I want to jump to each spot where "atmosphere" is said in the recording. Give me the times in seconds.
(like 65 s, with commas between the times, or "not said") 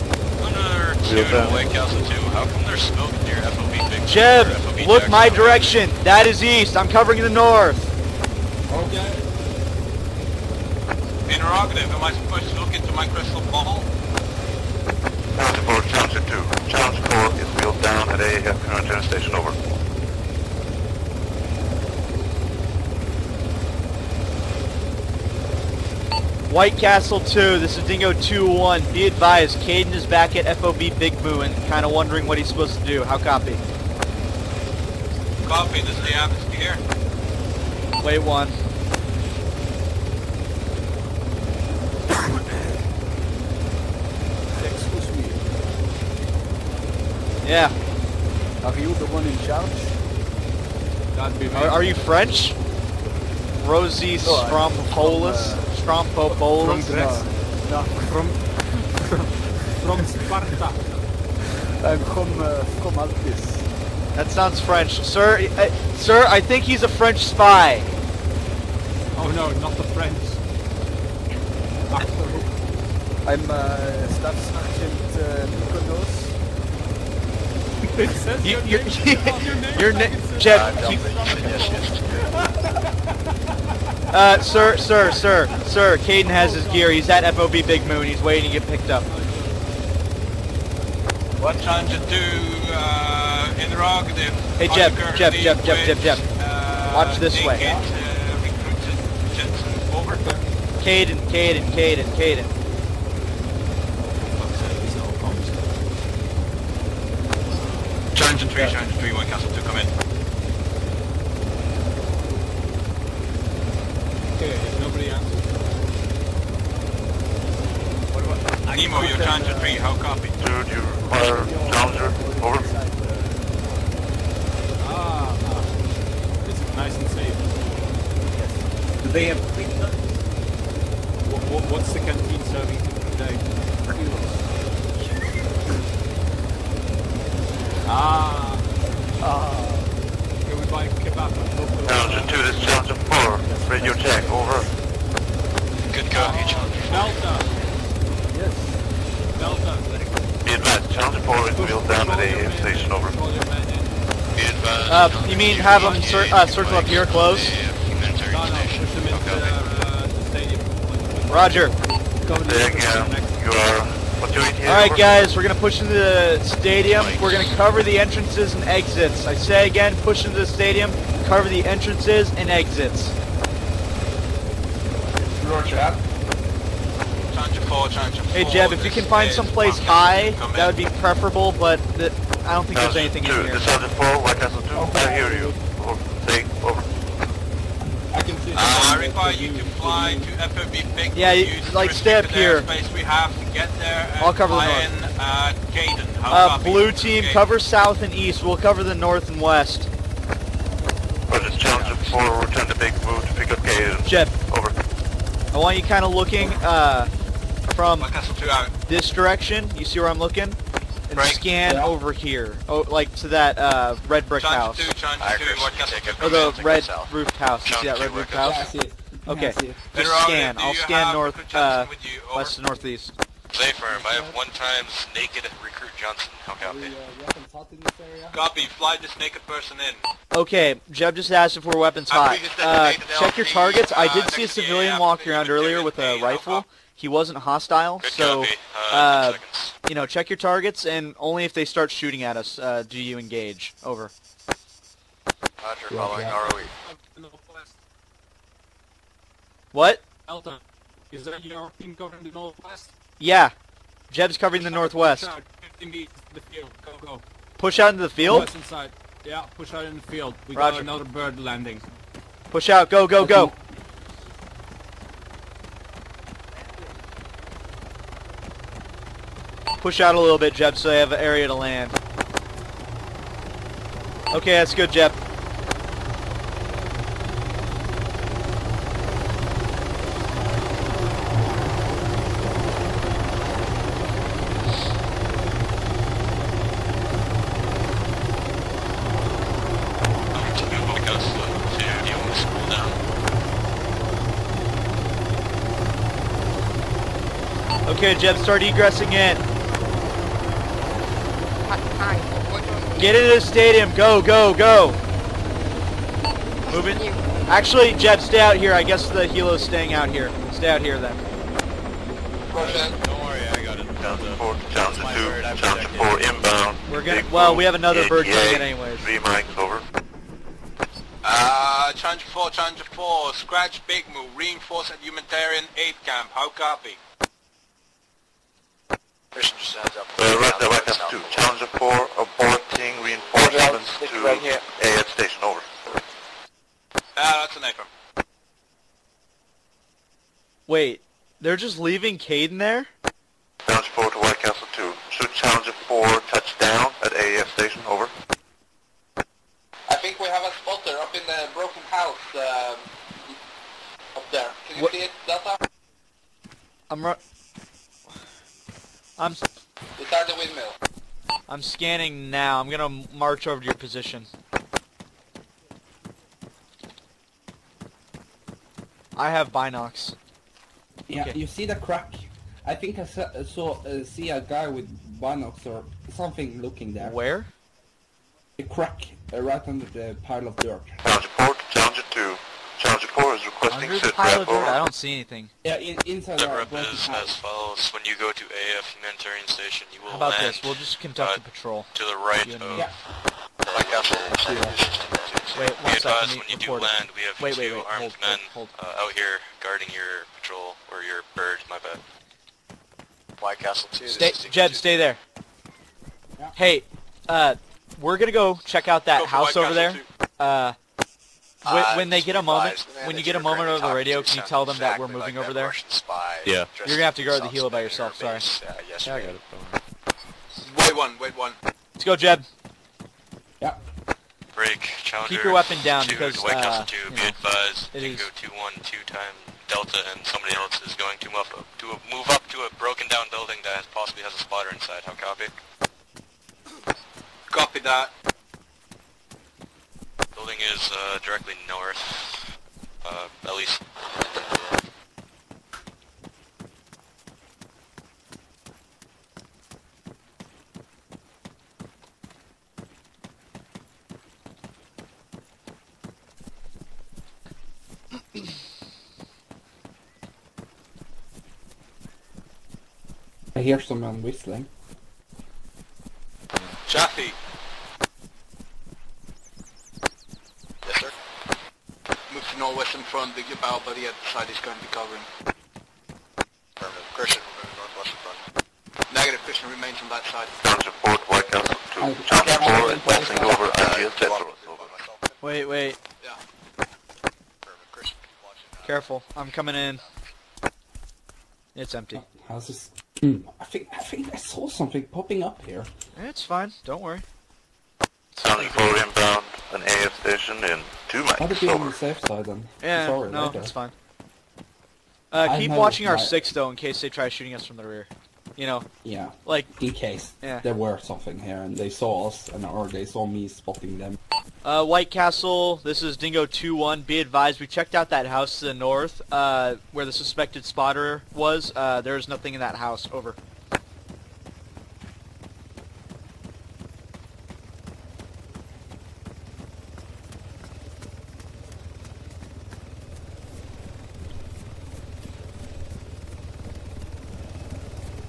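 36 s.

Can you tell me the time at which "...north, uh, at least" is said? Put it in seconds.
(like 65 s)
441 s.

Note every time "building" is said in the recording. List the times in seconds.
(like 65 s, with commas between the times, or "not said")
433 s, 440 s.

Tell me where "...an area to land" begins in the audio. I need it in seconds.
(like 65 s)
271 s.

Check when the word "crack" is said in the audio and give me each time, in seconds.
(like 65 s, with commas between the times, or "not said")
371 s, 378 s.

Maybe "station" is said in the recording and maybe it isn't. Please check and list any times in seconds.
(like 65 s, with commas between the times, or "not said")
19 s, 152 s, 335 s, 347 s, 389 s, 500 s.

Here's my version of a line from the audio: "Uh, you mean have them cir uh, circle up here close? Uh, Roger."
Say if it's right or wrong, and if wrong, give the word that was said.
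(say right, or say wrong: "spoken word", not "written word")
right.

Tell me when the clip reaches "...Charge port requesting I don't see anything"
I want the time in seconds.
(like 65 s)
382 s.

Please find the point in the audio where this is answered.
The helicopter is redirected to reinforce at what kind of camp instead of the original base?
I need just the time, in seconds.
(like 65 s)
325 s.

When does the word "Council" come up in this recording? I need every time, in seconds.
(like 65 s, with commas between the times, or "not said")
1 s, 15 s.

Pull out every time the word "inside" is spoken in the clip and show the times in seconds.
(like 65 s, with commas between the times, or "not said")
386 s, 434 s.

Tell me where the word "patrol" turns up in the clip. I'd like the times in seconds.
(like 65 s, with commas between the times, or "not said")
391 s, 400 s.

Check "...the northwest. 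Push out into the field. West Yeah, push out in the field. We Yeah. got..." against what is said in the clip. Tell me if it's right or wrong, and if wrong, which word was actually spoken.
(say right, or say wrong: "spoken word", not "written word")
wrong: "Roger", not "Yeah".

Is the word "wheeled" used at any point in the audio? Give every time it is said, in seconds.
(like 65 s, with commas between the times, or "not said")
17 s, 151 s.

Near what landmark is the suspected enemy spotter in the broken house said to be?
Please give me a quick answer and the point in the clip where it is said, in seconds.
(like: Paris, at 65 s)
The windmill, at 360 s.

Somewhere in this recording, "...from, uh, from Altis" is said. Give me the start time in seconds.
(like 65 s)
62 s.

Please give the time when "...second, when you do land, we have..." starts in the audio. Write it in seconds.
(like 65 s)
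395 s.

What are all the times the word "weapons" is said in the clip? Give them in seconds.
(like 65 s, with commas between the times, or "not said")
231 s, 425 s.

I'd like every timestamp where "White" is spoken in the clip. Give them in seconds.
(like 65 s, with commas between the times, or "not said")
26 s, 184 s, 344 s, 403 s, 426 s, 481 s, 514 s.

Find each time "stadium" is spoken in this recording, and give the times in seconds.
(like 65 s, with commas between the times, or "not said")
166 s, 170 s, 303 s.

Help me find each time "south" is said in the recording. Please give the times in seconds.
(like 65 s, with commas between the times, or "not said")
197 s, 216 s.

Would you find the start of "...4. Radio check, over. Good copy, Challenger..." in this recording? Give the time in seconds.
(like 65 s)
143 s.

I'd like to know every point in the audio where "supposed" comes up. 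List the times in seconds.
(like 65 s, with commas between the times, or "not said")
12 s, 32 s.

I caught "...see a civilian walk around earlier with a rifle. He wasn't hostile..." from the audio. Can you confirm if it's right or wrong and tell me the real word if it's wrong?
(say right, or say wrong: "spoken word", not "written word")
right.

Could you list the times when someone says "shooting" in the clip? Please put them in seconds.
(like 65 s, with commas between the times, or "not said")
241 s, 507 s.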